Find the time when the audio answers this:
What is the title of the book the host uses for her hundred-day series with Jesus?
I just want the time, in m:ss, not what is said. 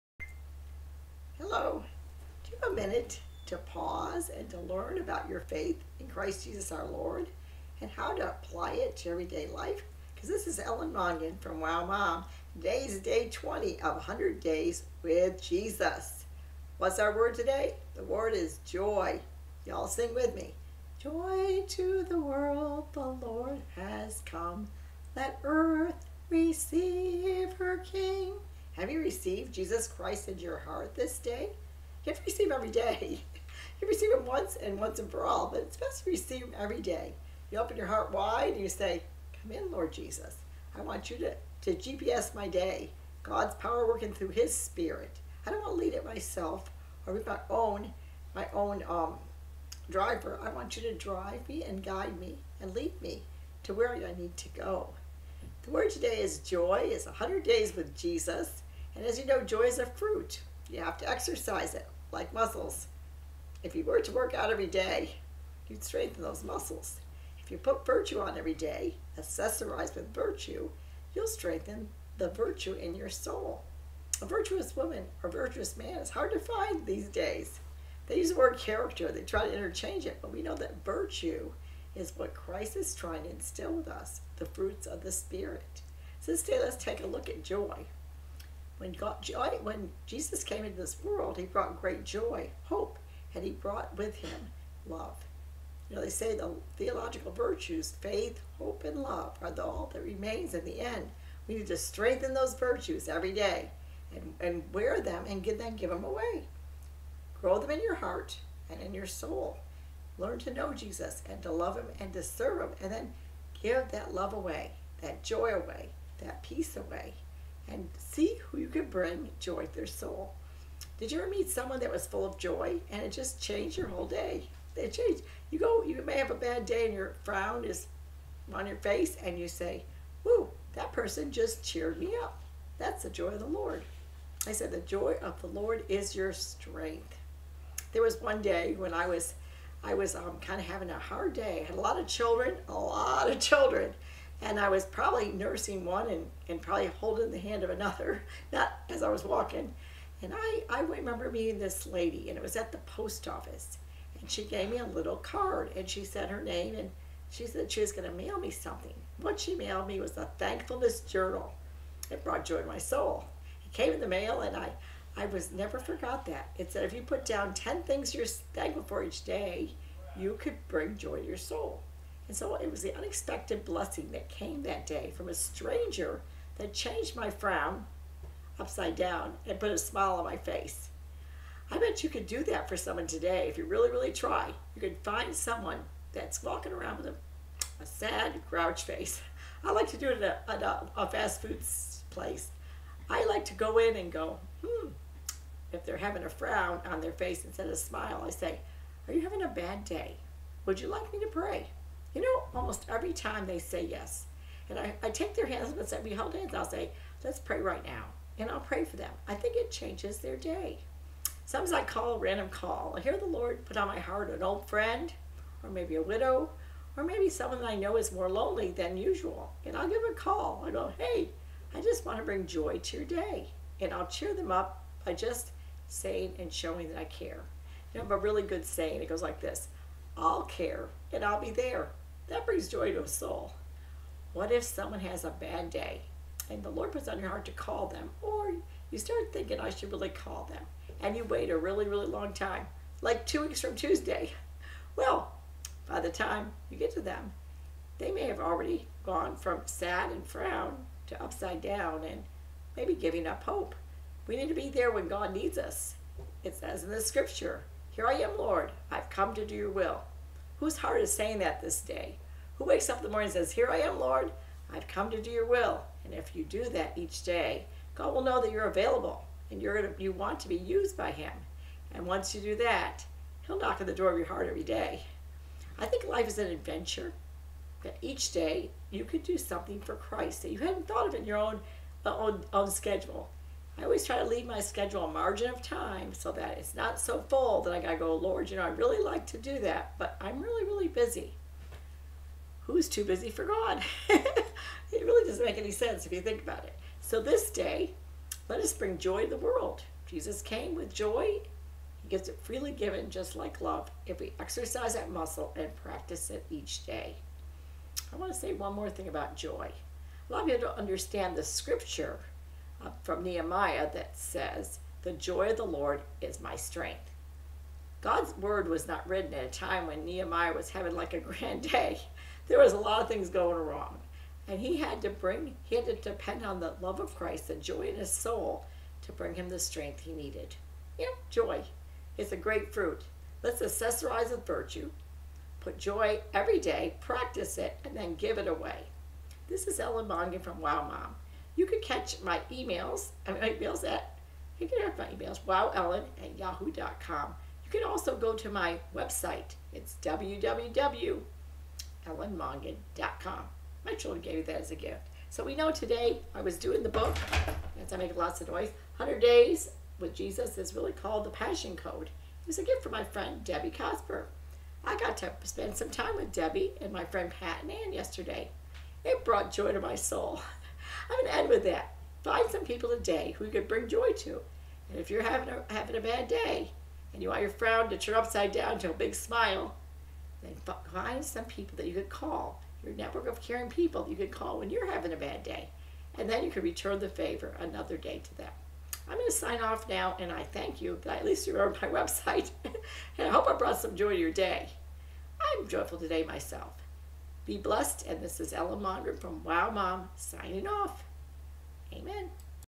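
6:01.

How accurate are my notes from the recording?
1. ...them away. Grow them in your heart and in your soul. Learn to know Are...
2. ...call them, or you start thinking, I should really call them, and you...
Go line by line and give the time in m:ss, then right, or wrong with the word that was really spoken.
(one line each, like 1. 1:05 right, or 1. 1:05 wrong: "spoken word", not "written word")
1. 1:45 wrong: "Jesus", not "Are"
2. 3:57 right.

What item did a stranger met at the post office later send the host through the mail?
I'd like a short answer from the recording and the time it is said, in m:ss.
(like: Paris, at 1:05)
A thankfulness journal, at 2:40.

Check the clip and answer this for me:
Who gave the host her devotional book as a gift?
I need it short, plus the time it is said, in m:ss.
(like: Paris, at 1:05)
Debbie Cosper, at 6:03.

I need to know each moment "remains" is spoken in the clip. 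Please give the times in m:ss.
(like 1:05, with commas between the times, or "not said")
1:40.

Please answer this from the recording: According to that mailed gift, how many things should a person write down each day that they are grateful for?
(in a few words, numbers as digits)
10.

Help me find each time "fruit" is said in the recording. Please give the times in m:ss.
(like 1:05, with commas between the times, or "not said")
0:59, 1:24, 5:32.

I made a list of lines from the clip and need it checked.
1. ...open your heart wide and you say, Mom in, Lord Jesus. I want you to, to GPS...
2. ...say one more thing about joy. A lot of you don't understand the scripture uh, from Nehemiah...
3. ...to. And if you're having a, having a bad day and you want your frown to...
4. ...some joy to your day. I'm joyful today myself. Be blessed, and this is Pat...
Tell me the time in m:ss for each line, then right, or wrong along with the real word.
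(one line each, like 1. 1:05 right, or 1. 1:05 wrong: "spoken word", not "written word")
1. 0:37 wrong: "Come", not "Mom"
2. 5:08 right
3. 6:14 right
4. 6:33 wrong: "Ellen", not "Pat".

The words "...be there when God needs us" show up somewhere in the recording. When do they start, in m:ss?
4:14.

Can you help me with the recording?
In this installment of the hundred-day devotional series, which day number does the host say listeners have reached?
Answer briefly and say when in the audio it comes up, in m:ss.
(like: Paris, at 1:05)
20, at 0:12.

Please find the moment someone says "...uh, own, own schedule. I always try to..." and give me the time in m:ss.
4:42.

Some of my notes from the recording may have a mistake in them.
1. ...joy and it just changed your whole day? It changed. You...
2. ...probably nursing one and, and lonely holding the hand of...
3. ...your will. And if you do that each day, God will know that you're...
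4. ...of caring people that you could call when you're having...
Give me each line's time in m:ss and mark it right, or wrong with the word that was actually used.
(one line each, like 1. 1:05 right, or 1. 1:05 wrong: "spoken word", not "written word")
1. 2:02 right
2. 2:24 wrong: "probably", not "lonely"
3. 4:25 right
4. 6:23 right.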